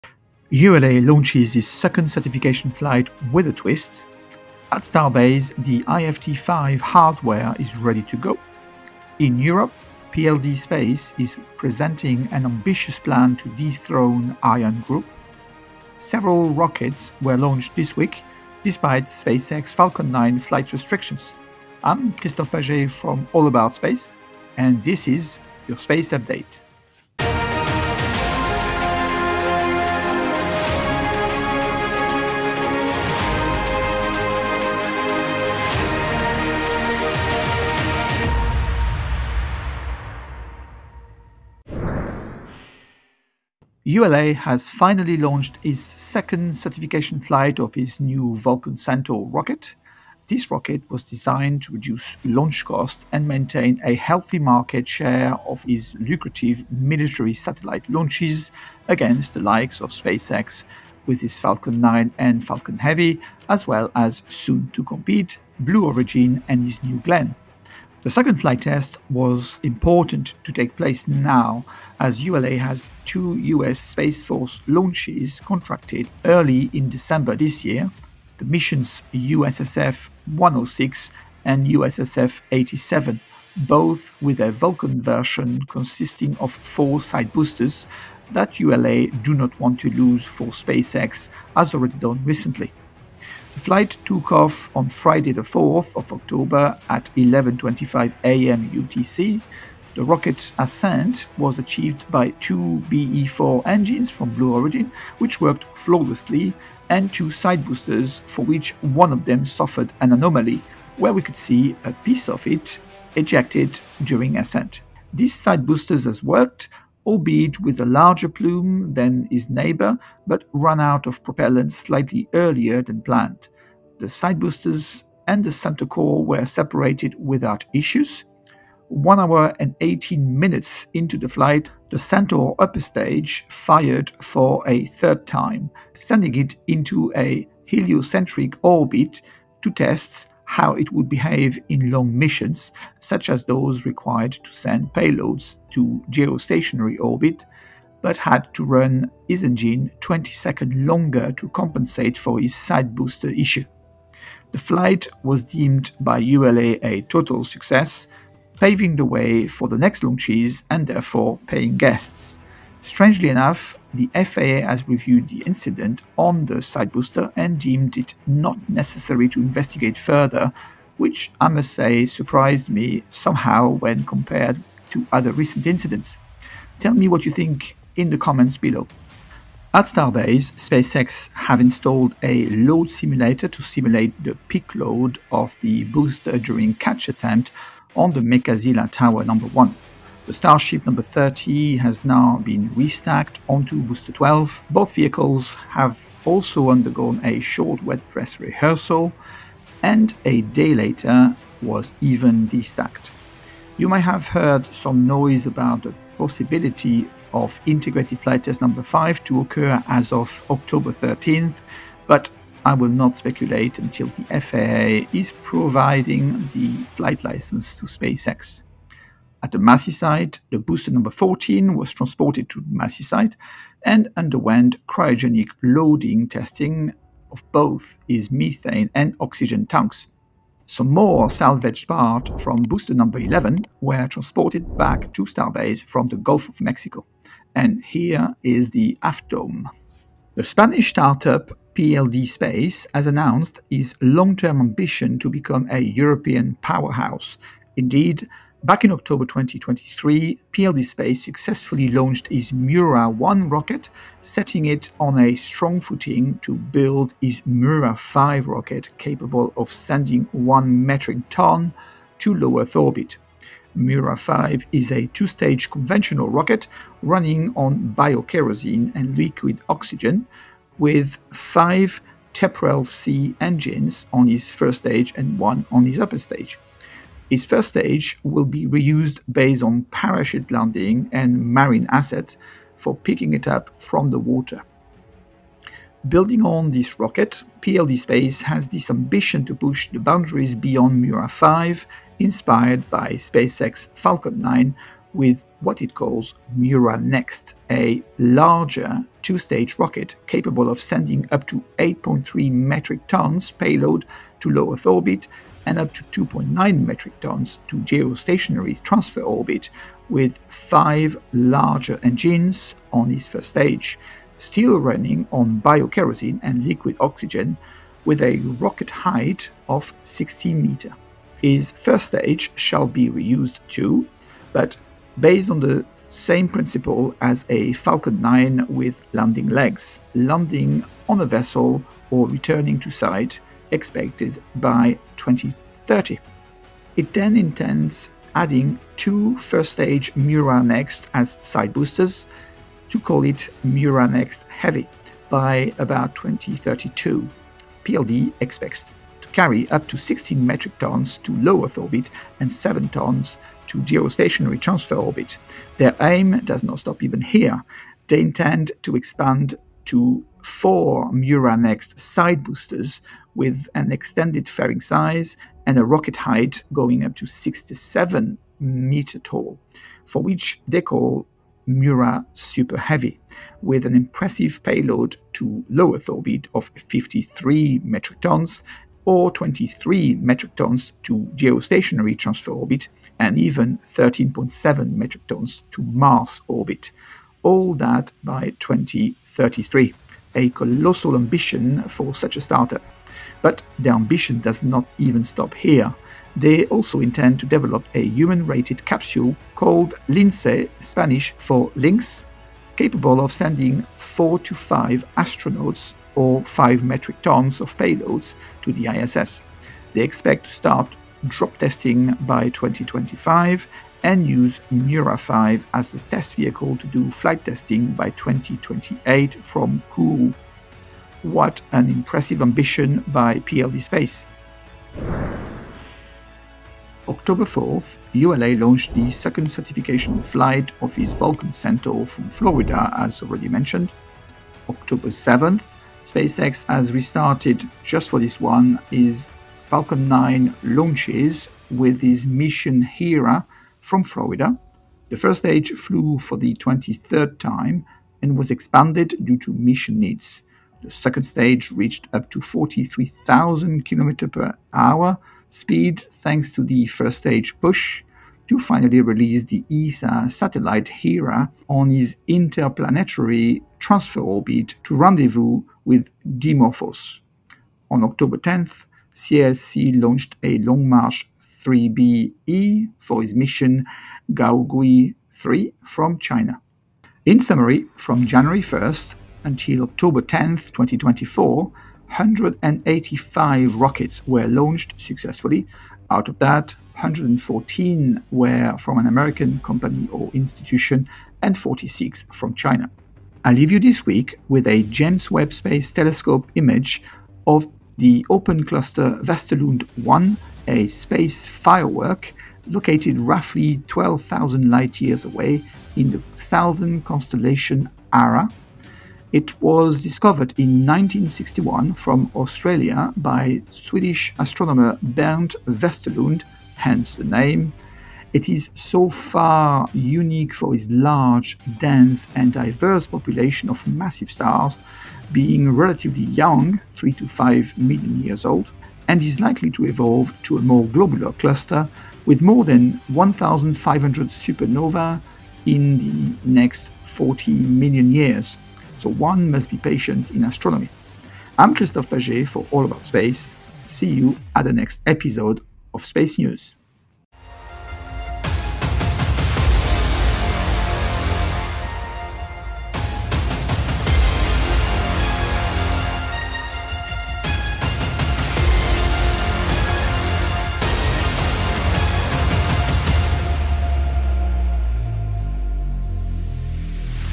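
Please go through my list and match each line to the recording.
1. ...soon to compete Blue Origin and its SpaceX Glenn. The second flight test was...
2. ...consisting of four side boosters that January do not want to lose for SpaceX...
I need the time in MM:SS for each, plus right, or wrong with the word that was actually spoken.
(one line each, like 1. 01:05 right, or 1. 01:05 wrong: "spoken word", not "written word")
1. 01:04 wrong: "New", not "SpaceX"
2. 01:25 wrong: "ULA", not "January".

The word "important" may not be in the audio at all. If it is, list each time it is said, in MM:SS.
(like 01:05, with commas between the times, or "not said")
01:09.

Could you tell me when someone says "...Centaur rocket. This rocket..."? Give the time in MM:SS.
00:48.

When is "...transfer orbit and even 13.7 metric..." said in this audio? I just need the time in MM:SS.
06:22.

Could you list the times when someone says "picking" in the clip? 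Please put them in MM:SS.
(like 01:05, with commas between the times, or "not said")
04:42.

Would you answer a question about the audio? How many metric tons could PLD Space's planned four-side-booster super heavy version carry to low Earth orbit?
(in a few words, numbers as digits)
53.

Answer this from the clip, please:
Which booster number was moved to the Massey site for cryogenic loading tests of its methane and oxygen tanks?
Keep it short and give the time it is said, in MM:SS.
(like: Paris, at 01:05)
14, at 03:41.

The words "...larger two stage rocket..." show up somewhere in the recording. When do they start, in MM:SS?
04:58.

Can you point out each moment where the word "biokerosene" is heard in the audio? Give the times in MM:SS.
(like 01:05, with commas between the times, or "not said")
04:27, 05:15.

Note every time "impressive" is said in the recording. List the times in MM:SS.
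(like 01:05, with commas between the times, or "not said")
06:13, 07:01.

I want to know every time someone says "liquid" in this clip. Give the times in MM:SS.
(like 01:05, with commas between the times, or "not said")
04:29, 05:16.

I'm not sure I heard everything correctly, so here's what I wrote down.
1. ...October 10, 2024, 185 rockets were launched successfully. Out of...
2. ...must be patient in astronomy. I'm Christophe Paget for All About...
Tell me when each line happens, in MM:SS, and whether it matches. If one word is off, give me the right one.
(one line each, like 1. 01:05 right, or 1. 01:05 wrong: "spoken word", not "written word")
1. 07:59 right
2. 08:59 right.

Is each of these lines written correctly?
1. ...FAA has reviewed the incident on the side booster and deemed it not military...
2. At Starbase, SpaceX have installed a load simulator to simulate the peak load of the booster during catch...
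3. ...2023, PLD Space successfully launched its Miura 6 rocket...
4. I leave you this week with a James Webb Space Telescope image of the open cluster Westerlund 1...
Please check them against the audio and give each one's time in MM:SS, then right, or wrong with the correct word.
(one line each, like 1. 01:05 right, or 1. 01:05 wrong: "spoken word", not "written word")
1. 02:44 wrong: "necessary", not "military"
2. 02:59 right
3. 04:09 wrong: "1", not "6"
4. 08:13 right.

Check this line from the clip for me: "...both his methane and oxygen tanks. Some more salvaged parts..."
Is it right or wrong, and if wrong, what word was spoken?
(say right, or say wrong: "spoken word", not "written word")
right.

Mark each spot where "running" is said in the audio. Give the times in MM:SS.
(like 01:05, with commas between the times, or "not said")
04:27, 05:14.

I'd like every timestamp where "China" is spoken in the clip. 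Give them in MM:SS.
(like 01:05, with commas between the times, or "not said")
07:56, 08:12.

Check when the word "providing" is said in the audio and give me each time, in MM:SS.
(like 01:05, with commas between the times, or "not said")
03:35.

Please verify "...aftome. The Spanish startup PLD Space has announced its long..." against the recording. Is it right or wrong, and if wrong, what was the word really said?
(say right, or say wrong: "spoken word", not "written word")
right.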